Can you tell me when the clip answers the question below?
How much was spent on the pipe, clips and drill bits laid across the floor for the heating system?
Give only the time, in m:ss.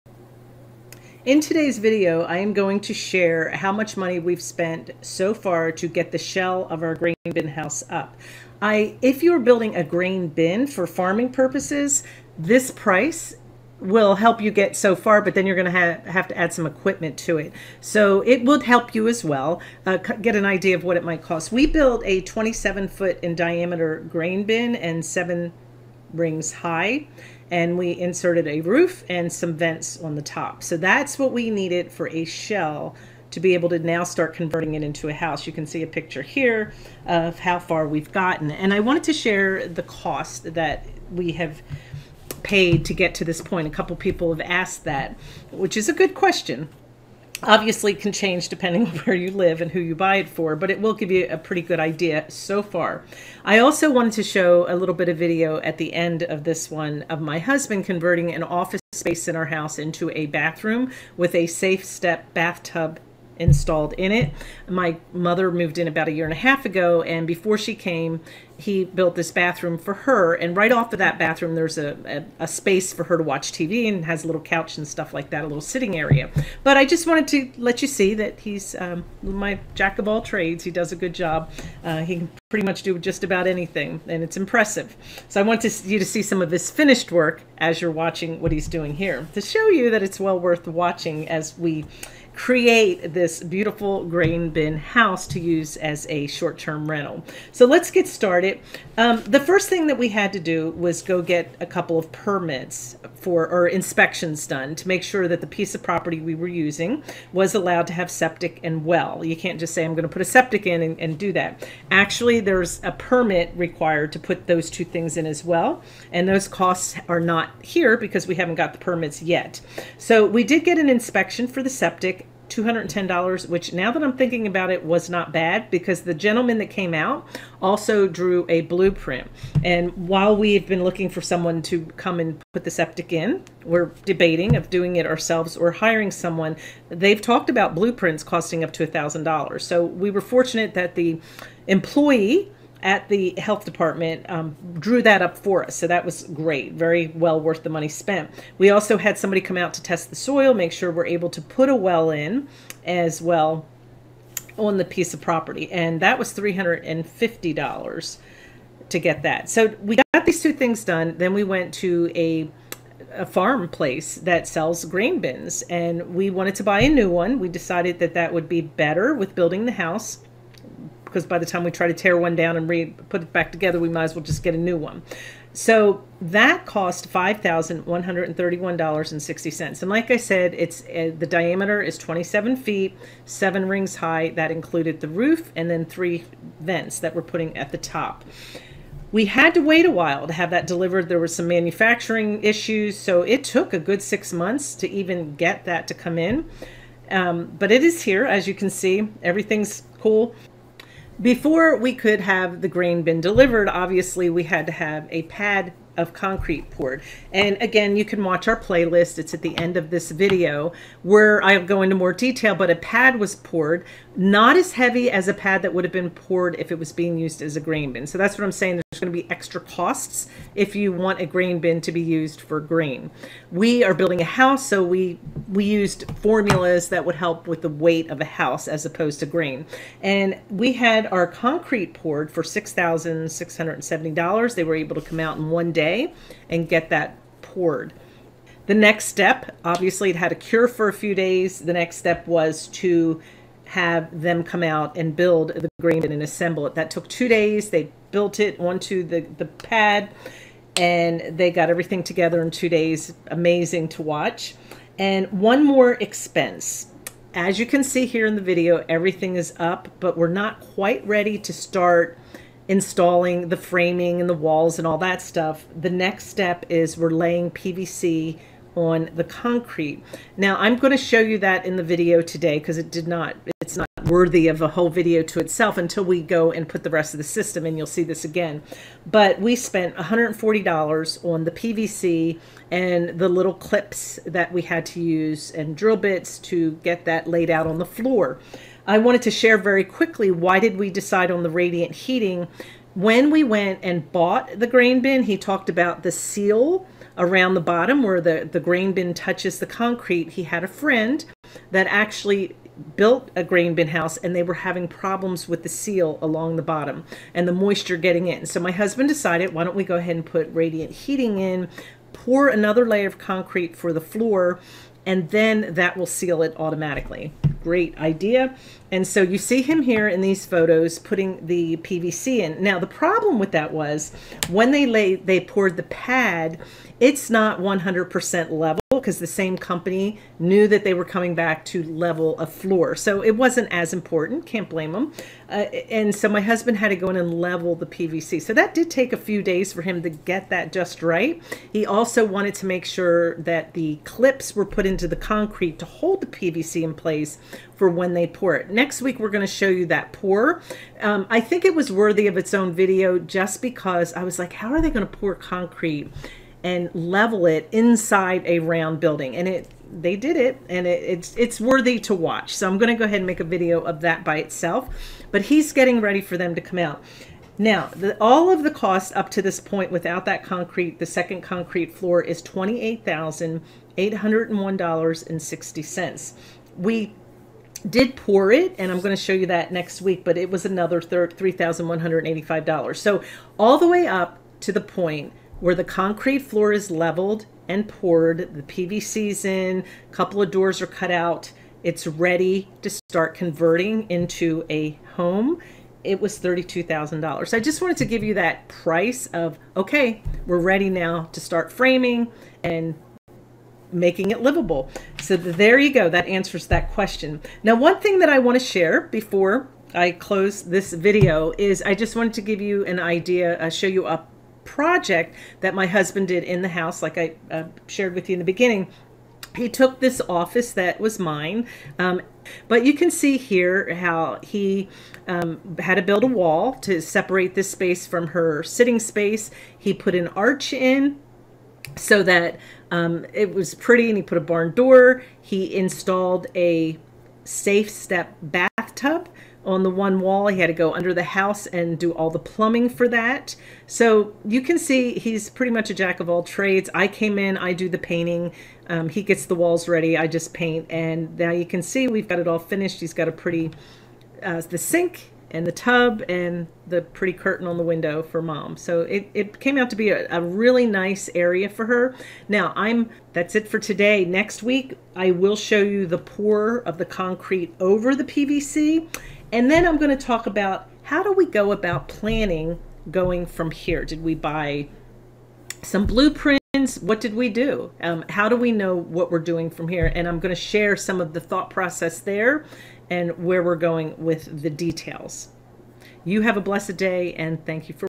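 4:39.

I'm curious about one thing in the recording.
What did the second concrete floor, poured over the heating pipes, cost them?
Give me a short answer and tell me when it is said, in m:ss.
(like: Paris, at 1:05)
$3,185, at 6:21.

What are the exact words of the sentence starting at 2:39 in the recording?
So we got these two things done.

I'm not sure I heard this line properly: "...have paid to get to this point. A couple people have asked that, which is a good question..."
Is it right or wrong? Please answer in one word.
right.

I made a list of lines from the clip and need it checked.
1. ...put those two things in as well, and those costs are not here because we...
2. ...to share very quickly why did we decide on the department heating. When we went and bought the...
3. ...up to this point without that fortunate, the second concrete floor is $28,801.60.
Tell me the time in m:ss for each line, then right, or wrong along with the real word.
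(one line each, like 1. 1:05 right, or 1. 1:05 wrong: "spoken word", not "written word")
1. 1:54 right
2. 4:49 wrong: "radiant", not "department"
3. 6:09 wrong: "concrete", not "fortunate".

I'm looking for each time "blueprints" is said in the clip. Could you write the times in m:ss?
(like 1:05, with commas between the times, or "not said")
2:08, 2:17, 7:56.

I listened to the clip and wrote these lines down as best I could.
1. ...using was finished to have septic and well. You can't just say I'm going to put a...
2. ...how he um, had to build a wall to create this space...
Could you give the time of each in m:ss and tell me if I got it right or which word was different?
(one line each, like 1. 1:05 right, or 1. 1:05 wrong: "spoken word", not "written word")
1. 1:46 wrong: "allowed", not "finished"
2. 7:03 wrong: "separate", not "create".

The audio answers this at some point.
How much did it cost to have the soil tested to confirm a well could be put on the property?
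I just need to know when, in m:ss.
2:36.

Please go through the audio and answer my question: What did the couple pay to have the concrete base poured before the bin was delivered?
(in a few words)
$6,670.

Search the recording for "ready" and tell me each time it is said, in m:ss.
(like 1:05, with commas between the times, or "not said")
4:21, 6:06, 6:32, 6:40, 7:29.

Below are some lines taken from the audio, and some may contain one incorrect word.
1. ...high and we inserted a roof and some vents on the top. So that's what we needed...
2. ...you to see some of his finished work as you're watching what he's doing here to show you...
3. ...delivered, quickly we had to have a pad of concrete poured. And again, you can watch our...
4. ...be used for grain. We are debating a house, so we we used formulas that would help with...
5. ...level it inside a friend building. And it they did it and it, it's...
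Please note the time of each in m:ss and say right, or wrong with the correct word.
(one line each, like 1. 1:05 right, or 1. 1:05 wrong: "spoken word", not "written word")
1. 0:26 right
2. 1:25 right
3. 3:23 wrong: "obviously", not "quickly"
4. 3:41 wrong: "building", not "debating"
5. 5:56 wrong: "round", not "friend".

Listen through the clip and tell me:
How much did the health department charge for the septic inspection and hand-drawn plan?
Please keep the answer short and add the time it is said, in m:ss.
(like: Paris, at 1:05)
$210, at 2:02.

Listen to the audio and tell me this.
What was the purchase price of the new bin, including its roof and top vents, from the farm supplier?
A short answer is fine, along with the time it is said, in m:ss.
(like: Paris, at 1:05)
$5,131.60, at 2:57.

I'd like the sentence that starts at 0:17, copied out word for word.
So it would help you as well uh, get an idea of what it might cost.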